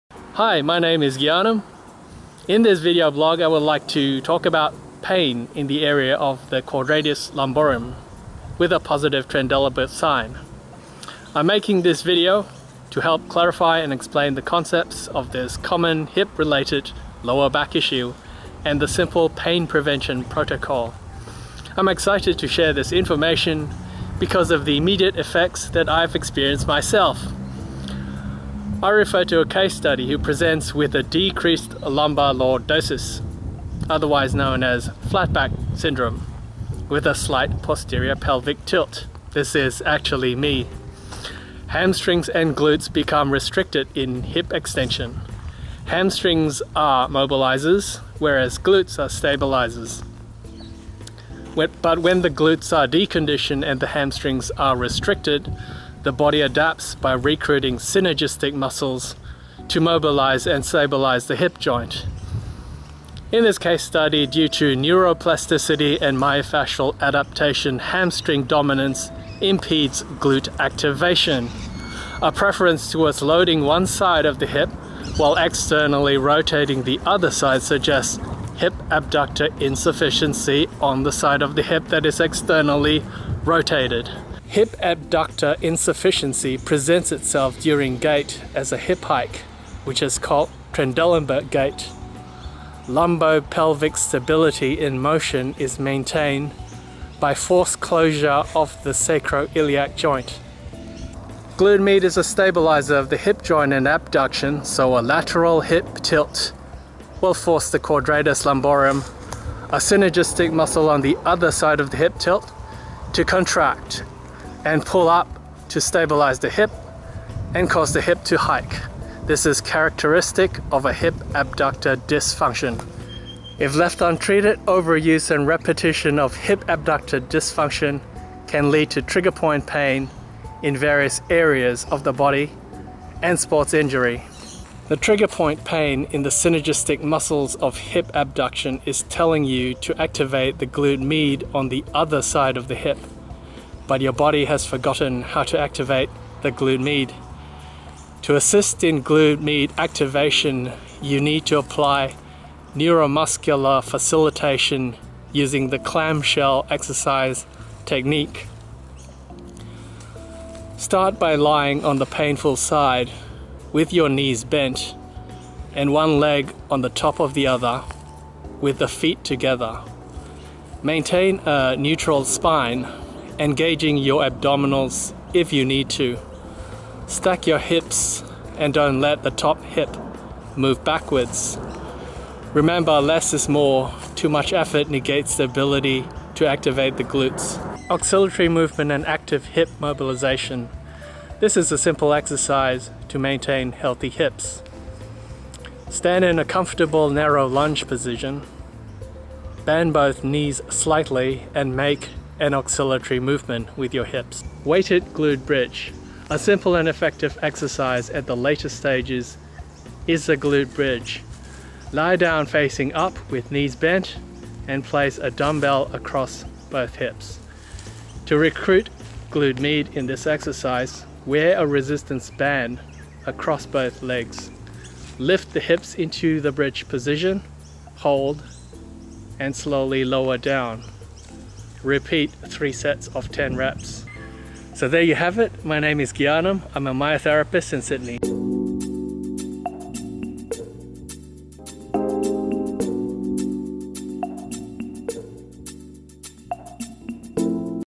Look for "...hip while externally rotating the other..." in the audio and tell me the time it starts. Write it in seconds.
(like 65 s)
74 s.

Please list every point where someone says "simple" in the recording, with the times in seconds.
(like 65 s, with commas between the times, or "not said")
18 s, 191 s, 206 s.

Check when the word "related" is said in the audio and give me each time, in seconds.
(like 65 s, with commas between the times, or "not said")
16 s.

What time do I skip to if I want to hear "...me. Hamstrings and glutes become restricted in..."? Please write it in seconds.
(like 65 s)
40 s.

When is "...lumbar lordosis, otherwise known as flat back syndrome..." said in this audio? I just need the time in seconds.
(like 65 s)
31 s.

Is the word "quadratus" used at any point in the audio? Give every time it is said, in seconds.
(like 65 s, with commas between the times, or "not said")
6 s, 107 s.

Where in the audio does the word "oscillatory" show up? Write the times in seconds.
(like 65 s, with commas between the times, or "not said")
187 s, 202 s.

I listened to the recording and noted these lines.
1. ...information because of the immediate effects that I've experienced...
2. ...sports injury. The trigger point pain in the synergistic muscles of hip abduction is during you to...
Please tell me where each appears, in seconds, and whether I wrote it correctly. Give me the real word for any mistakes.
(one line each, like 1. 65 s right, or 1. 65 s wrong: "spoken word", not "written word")
1. 22 s right
2. 133 s wrong: "telling", not "during".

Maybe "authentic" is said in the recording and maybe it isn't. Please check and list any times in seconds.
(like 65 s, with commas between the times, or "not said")
not said.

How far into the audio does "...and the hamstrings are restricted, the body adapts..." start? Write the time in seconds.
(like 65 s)
53 s.